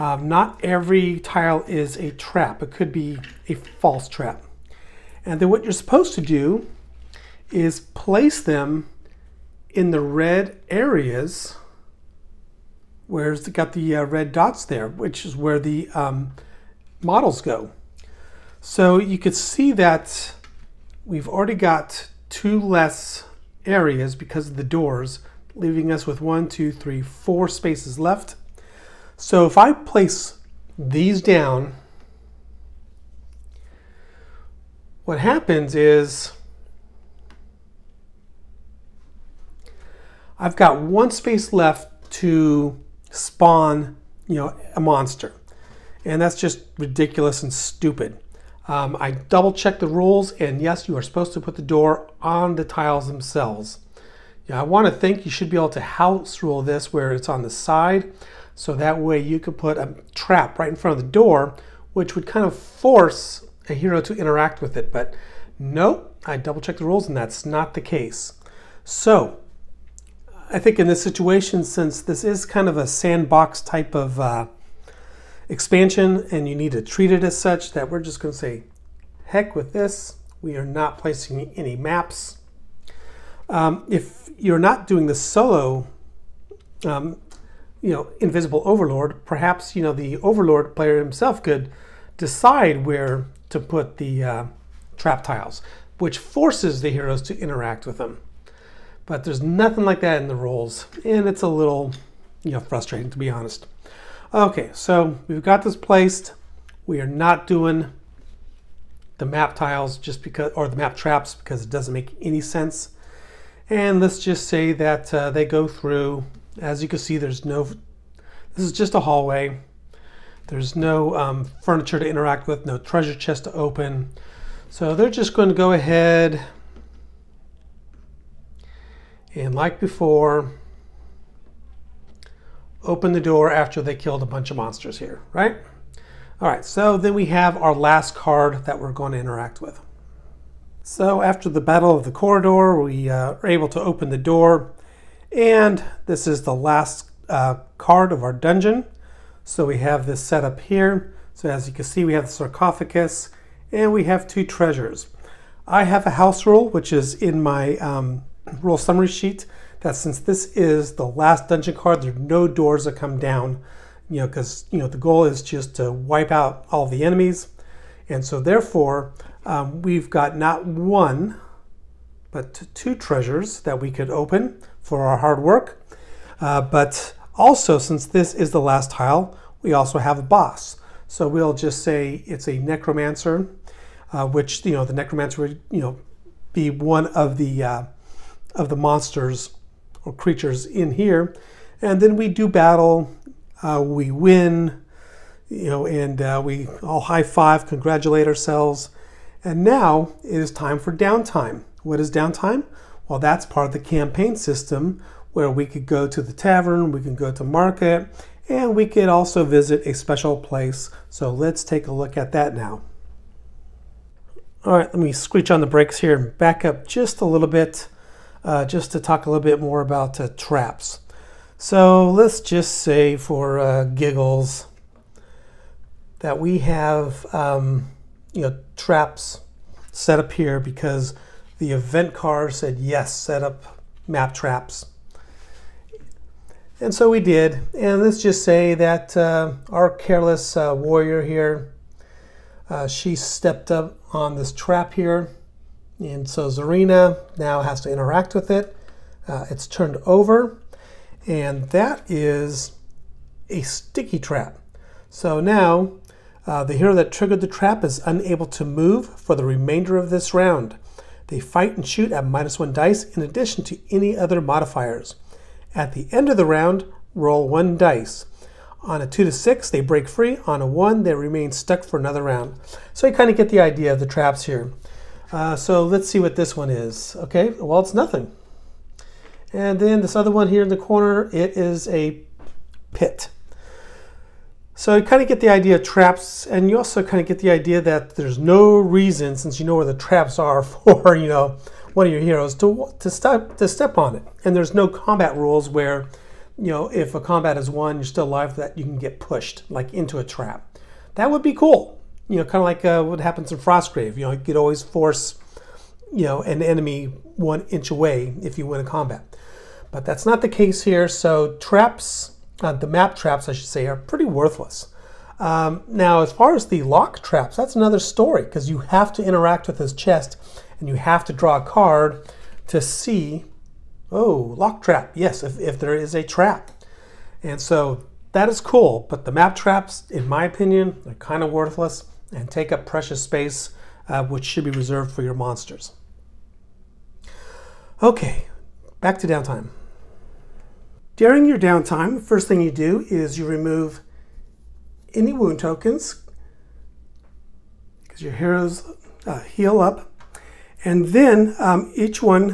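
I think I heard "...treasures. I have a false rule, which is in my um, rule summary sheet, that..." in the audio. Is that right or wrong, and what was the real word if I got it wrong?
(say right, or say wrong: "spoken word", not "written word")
wrong: "house", not "false".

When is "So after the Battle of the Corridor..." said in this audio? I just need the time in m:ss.
2:20.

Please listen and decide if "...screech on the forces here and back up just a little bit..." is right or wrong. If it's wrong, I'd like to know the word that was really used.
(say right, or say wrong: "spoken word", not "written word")
wrong: "brakes", not "forces".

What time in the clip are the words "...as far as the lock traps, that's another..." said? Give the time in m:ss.
5:16.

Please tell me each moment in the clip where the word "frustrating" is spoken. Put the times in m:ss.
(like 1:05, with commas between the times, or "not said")
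1:42.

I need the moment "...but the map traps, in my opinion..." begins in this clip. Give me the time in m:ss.
5:29.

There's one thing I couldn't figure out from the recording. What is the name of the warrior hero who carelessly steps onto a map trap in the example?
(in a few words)
Zarina.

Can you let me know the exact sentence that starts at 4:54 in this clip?
And there's no combat rules where, you know, if a combat is won, you're still alive.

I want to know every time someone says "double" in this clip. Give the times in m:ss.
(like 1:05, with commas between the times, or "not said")
0:49, 1:06.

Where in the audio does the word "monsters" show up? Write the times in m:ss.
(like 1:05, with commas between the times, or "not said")
0:44, 2:14, 3:08, 5:35.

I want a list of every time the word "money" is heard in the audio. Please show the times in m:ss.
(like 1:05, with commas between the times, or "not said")
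not said.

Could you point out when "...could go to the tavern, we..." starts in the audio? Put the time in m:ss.
3:25.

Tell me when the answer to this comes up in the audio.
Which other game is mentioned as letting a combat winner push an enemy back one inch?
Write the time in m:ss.
5:03.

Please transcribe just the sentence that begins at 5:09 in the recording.
But that's not the case here.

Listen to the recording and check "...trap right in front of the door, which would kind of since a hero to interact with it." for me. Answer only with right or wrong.
wrong.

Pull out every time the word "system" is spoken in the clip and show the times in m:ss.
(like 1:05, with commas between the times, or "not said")
3:24.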